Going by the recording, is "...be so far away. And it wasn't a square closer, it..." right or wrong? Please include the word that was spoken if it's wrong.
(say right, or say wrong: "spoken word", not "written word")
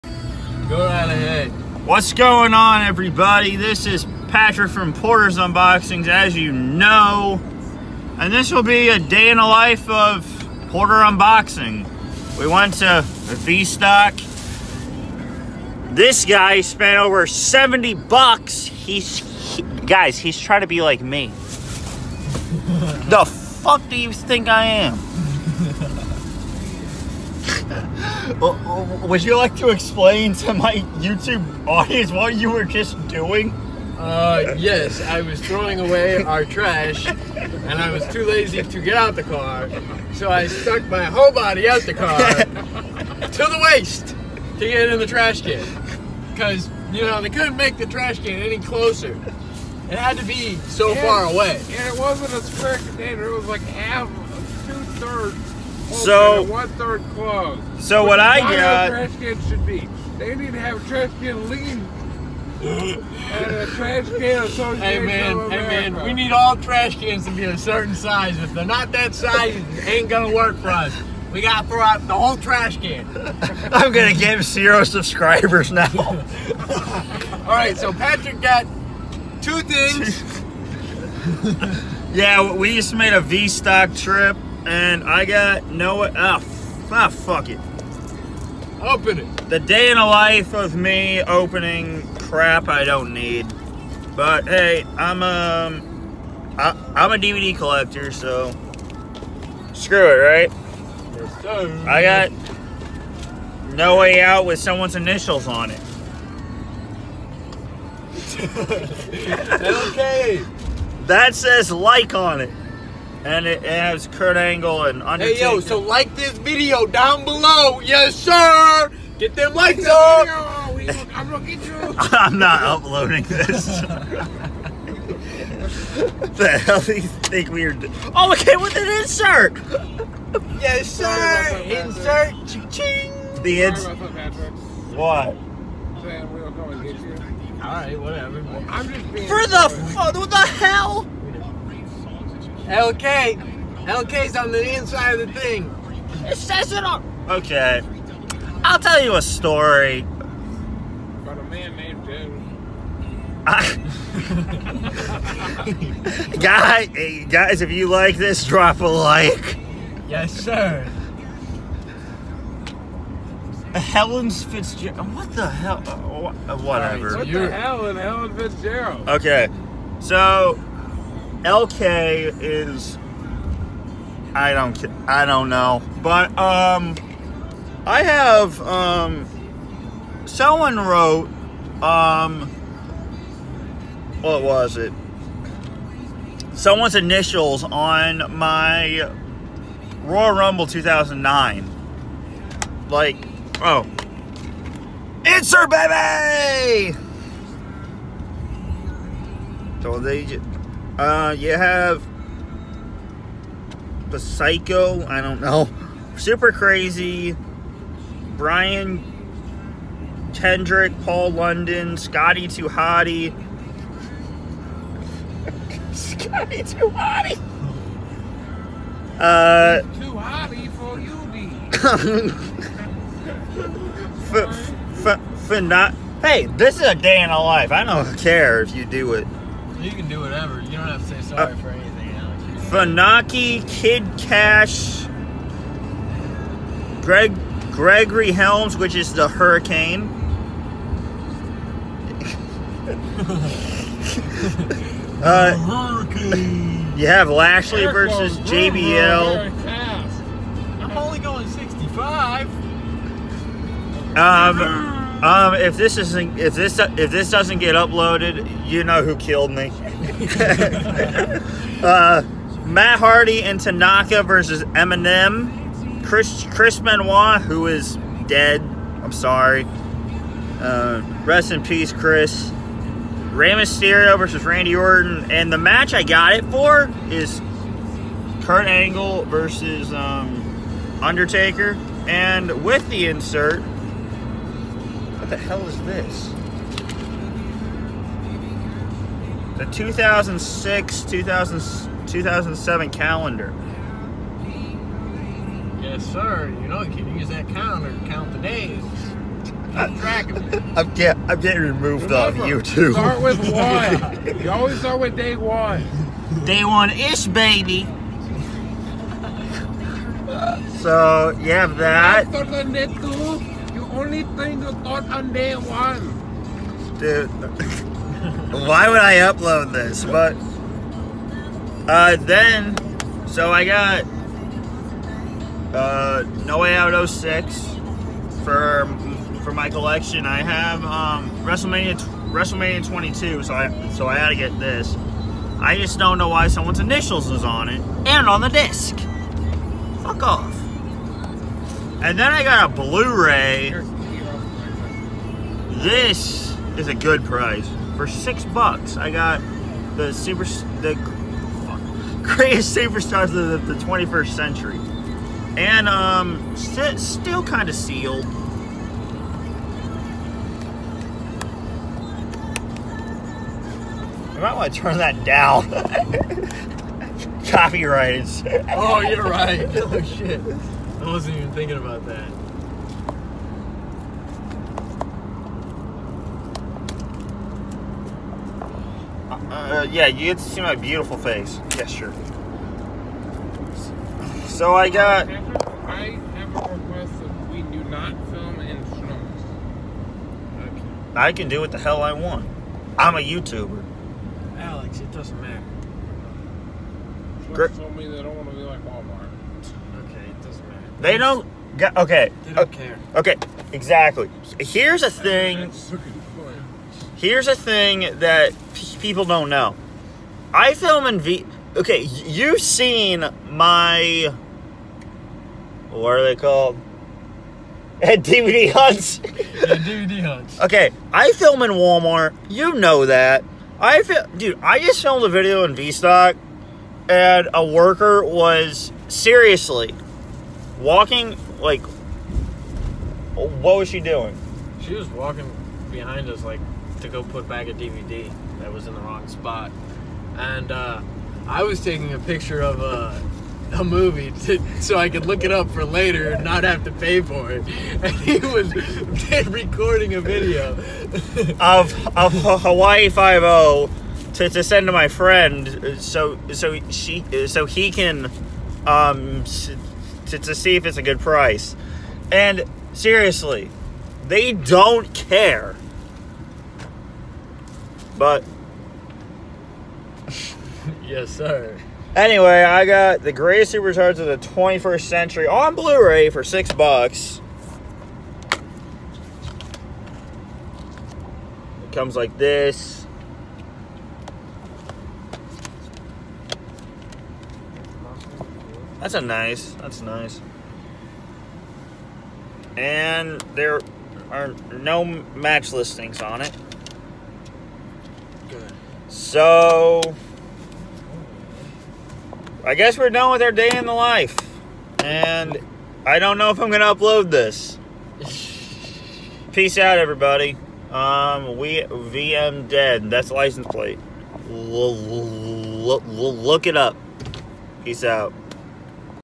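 wrong: "container", not "closer".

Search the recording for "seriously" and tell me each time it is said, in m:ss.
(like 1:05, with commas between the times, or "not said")
7:09, 7:42.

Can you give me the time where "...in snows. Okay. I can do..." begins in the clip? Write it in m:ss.
6:28.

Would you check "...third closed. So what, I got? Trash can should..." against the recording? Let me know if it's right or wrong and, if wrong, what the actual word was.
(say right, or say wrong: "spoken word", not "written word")
right.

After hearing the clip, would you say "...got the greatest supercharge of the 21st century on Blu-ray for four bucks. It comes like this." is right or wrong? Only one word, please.
wrong.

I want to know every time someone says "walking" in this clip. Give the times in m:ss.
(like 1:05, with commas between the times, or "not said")
7:10, 7:15.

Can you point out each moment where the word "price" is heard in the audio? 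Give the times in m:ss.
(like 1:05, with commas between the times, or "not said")
5:47, 7:41.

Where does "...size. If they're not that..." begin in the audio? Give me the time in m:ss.
1:07.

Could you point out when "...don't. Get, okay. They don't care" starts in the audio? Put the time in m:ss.
6:41.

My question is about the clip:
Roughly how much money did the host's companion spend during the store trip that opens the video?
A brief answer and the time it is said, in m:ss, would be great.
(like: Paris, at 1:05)
over 70 bucks, at 0:16.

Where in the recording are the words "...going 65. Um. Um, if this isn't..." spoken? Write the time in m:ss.
4:11.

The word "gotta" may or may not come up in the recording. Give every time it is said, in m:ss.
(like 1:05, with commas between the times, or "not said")
1:11.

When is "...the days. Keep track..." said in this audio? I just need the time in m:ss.
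4:58.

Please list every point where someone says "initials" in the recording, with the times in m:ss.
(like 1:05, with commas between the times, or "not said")
1:44, 3:06, 5:36.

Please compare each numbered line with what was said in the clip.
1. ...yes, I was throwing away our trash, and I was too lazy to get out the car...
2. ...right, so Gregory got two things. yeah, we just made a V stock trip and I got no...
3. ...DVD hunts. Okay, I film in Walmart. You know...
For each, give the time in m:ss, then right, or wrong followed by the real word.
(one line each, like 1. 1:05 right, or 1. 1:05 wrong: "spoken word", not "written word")
1. 0:34 right
2. 1:17 wrong: "Patrick", not "Gregory"
3. 6:59 right.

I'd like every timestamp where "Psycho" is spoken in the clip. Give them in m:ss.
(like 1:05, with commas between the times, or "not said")
3:24.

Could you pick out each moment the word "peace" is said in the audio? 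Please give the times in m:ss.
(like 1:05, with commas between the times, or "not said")
4:31, 8:29, 8:37.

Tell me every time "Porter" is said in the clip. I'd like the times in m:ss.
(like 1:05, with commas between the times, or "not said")
0:04, 0:10.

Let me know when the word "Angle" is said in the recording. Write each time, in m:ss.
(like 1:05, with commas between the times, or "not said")
1:54, 4:38.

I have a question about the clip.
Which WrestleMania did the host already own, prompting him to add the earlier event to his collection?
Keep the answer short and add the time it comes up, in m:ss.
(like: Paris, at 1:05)
WrestleMania 22, at 5:32.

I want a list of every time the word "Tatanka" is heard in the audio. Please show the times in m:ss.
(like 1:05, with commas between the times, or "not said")
4:23.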